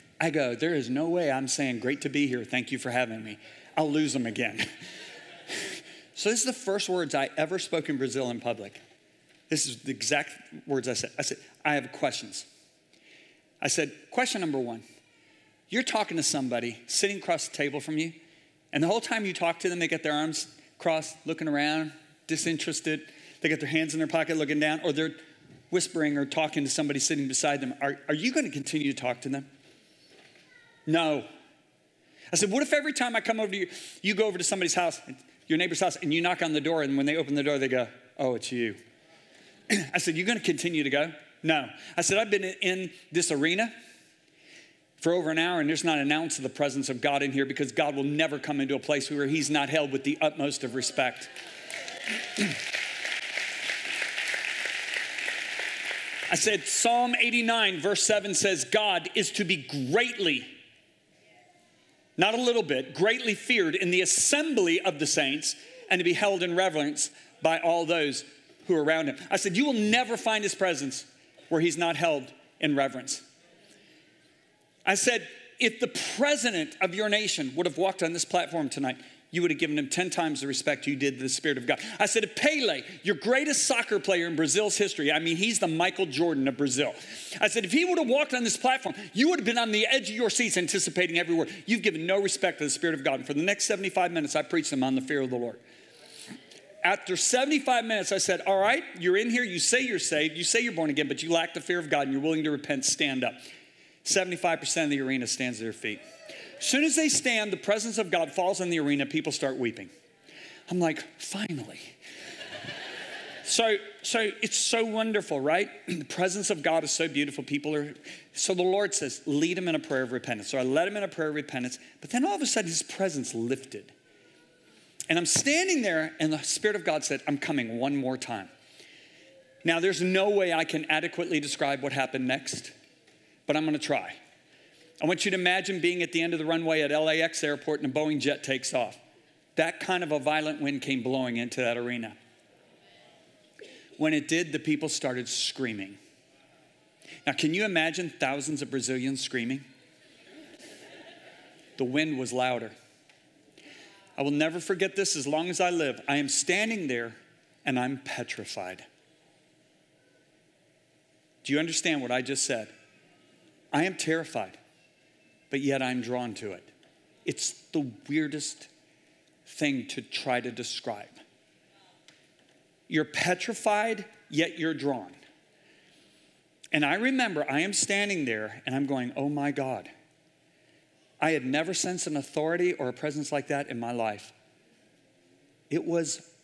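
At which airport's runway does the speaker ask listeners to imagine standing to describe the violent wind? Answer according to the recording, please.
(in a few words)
LAX.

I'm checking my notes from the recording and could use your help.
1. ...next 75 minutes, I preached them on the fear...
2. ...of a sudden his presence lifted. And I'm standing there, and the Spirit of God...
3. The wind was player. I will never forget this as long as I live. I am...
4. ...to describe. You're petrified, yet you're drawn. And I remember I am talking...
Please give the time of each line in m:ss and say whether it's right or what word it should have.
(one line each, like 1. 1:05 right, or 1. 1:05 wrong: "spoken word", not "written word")
1. 1:33 right
2. 2:02 right
3. 2:31 wrong: "louder", not "player"
4. 2:50 wrong: "standing", not "talking".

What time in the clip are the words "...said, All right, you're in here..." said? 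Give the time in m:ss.
1:38.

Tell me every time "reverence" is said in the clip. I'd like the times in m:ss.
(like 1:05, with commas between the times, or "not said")
1:06, 1:12.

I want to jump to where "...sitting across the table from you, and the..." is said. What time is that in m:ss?
0:16.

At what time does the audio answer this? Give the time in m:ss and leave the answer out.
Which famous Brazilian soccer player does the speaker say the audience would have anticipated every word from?
1:22.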